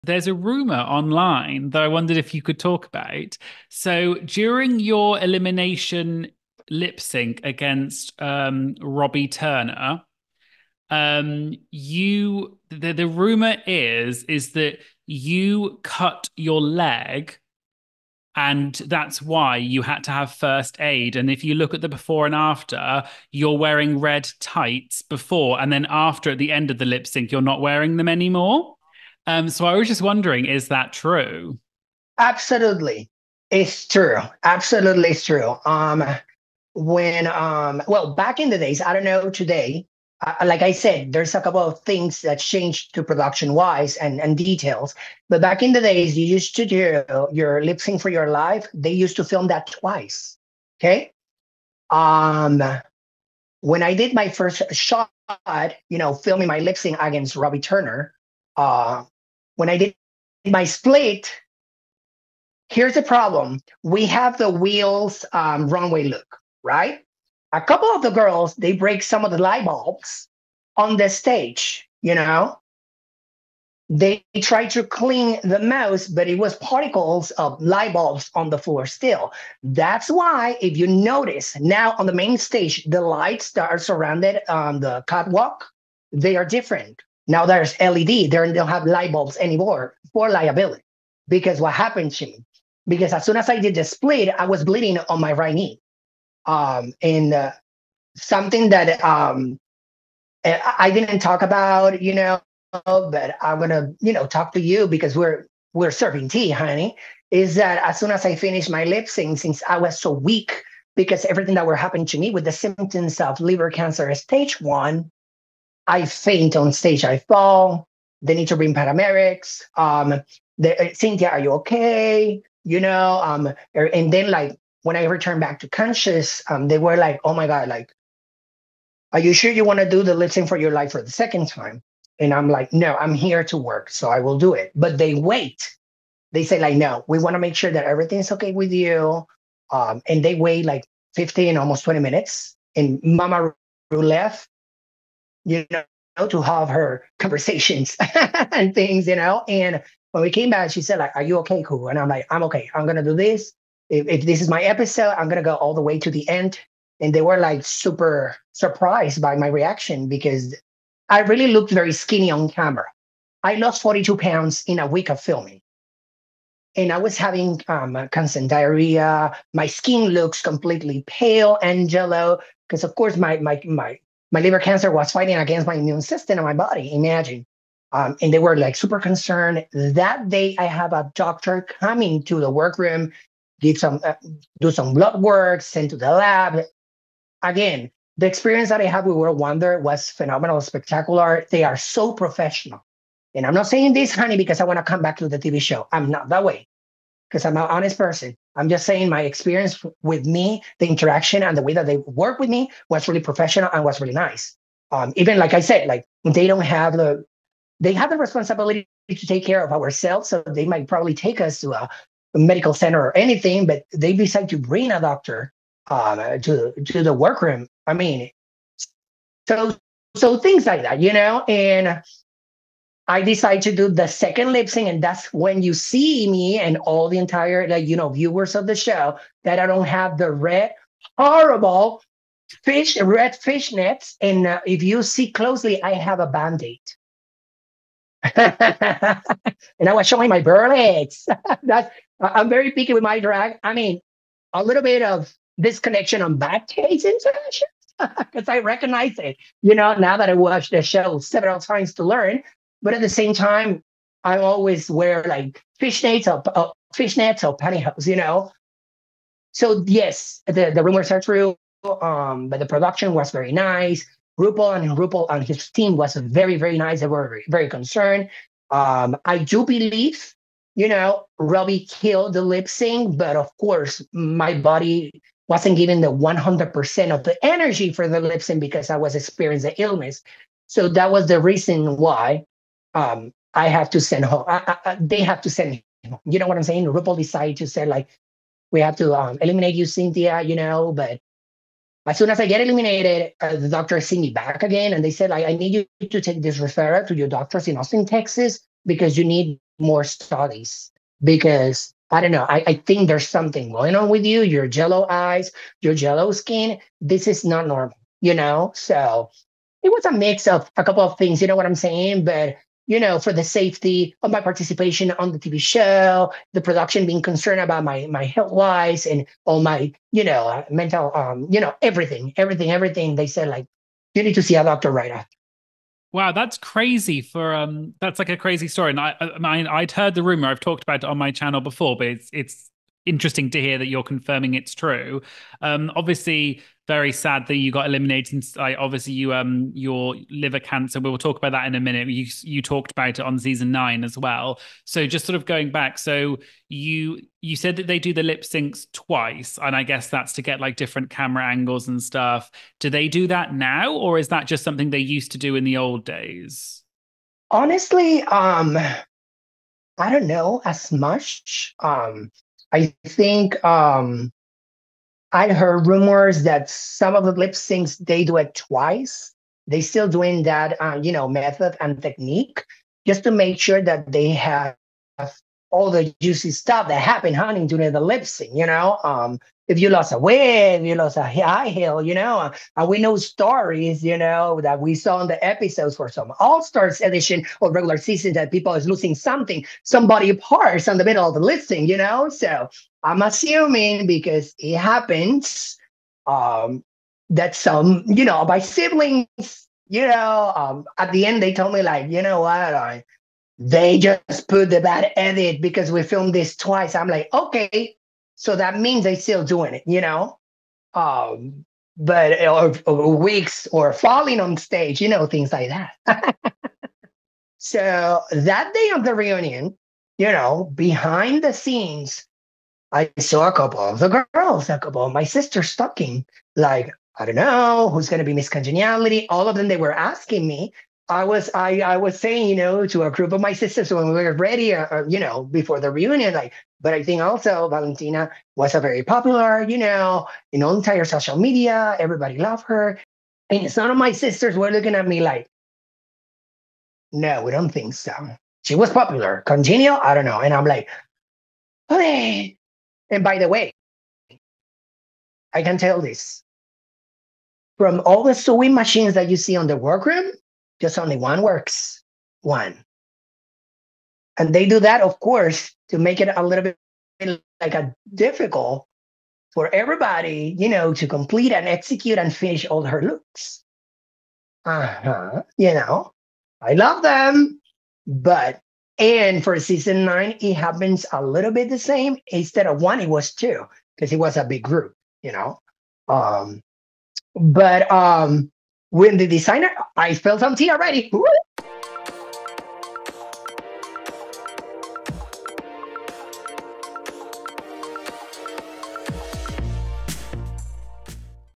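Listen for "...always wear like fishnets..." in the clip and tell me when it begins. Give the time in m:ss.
4:14.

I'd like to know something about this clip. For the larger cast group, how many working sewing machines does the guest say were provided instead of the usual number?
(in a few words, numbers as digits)
2.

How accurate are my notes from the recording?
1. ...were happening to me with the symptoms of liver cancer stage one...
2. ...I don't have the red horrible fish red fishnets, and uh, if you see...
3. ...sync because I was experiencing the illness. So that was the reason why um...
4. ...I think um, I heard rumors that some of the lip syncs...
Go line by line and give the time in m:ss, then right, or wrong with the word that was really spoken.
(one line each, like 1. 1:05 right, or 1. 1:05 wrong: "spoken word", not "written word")
1. 1:51 right
2. 3:49 right
3. 4:38 right
4. 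6:02 right.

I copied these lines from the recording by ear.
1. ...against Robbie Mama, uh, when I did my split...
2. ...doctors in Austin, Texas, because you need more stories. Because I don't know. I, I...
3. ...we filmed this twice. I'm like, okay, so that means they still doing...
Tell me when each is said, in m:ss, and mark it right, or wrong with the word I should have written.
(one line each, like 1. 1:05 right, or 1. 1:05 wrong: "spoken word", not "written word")
1. 0:57 wrong: "Turner", not "Mama"
2. 4:57 wrong: "studies", not "stories"
3. 6:45 right.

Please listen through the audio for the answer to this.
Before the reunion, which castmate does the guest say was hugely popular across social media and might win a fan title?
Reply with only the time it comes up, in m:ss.
7:17.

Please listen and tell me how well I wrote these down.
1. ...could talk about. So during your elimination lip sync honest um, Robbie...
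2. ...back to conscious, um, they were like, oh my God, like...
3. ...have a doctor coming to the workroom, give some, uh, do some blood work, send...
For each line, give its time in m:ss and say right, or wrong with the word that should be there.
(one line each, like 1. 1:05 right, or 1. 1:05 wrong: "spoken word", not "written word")
1. 0:02 wrong: "against", not "honest"
2. 2:05 right
3. 3:00 right.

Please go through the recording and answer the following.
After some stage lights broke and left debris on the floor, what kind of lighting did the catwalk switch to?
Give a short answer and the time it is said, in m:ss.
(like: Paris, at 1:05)
LED, at 1:27.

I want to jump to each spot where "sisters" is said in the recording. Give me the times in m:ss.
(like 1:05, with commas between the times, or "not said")
7:05, 7:13, 7:24.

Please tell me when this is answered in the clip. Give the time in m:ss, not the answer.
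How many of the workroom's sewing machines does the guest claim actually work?
7:40.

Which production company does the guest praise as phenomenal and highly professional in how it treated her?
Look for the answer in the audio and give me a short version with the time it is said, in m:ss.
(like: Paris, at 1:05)
World Wonder, at 3:09.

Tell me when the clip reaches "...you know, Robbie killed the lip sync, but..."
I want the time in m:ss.
4:30.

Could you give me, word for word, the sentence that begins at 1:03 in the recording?
We have the wheels um, runway look, right?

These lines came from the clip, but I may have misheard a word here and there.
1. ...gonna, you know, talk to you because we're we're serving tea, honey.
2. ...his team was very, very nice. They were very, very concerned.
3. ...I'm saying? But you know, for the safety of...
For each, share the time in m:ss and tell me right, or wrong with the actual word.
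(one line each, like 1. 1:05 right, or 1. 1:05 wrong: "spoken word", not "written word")
1. 1:43 right
2. 4:25 right
3. 5:11 right.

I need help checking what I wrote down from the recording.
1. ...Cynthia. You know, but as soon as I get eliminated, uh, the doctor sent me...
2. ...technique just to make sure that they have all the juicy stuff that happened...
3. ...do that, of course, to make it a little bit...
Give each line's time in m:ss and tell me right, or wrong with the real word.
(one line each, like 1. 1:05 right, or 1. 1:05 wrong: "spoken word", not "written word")
1. 4:49 right
2. 6:12 right
3. 7:44 right.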